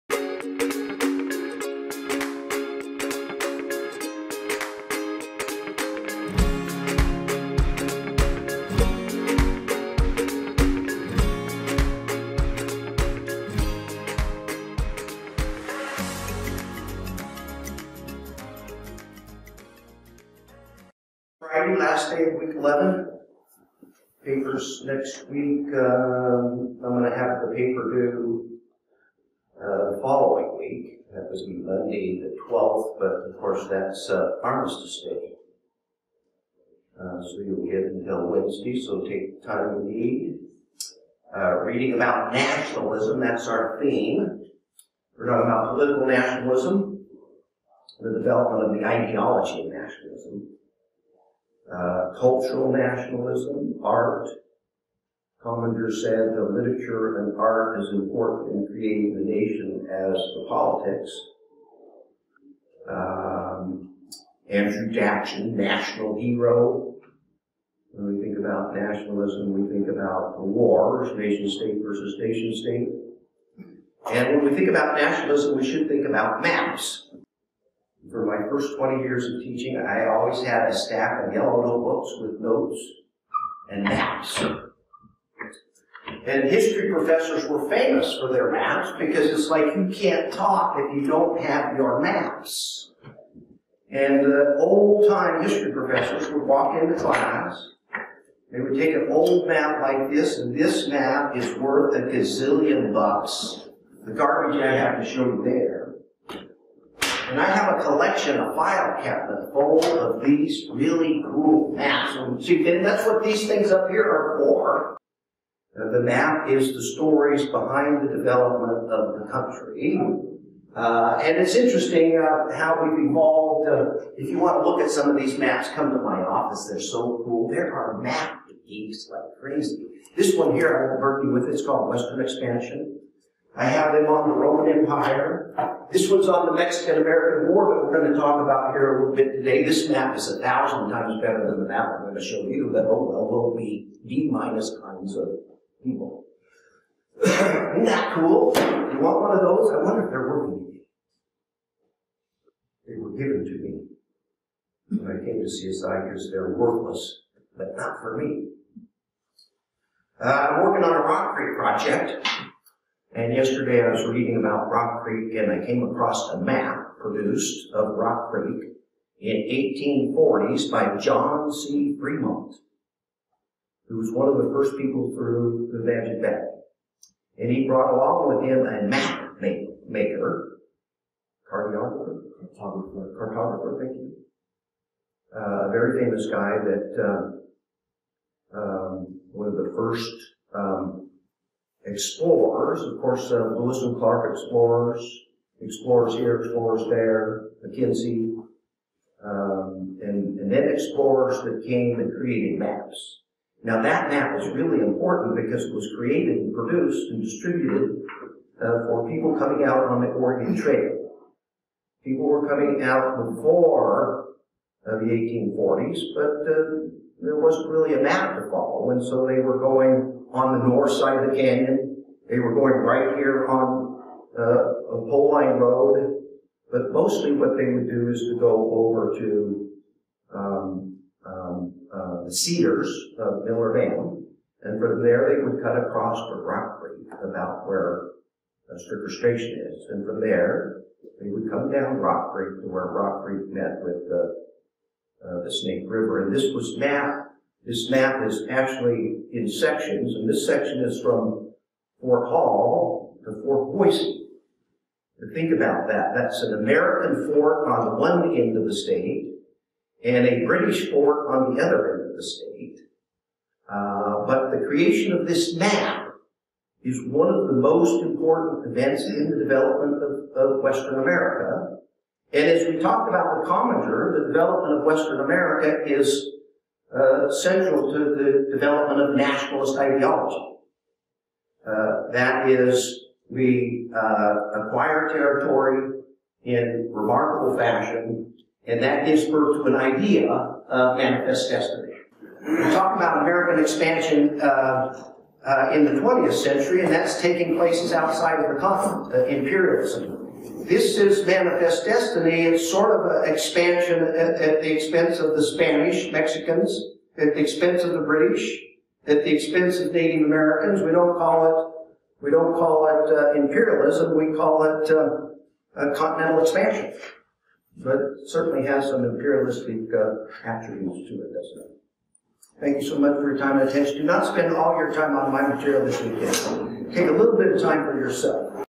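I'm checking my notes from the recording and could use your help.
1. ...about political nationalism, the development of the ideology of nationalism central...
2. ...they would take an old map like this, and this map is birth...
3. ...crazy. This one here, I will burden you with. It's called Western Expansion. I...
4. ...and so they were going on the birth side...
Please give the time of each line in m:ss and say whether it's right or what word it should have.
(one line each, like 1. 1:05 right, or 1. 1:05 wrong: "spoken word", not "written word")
1. 0:45 wrong: "cultural", not "central"
2. 1:38 wrong: "worth", not "birth"
3. 2:09 right
4. 3:38 wrong: "north", not "birth".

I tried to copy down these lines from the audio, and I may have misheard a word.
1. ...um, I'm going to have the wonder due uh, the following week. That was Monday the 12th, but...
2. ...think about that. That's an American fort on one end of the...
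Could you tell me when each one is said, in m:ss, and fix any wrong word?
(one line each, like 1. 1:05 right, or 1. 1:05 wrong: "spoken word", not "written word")
1. 0:25 wrong: "paper", not "wonder"
2. 4:15 right.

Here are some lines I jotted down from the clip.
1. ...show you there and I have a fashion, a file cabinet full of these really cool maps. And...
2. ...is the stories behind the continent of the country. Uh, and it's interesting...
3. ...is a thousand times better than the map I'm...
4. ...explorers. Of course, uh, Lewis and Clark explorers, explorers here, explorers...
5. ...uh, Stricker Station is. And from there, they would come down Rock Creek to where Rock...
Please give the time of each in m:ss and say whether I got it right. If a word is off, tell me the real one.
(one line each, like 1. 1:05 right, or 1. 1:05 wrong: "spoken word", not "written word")
1. 1:45 wrong: "collection", not "fashion"
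2. 1:56 wrong: "development", not "continent"
3. 2:20 right
4. 3:11 right
5. 3:58 right.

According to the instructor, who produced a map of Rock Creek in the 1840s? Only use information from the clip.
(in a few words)
John C. Fremont.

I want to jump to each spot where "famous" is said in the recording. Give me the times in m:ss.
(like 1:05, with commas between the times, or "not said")
1:27, 3:05.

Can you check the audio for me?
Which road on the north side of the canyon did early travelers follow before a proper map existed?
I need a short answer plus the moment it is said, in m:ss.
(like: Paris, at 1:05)
Pole Line Road, at 3:45.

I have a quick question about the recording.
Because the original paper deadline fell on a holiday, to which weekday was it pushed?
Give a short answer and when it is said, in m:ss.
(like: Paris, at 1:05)
Wednesday, at 0:38.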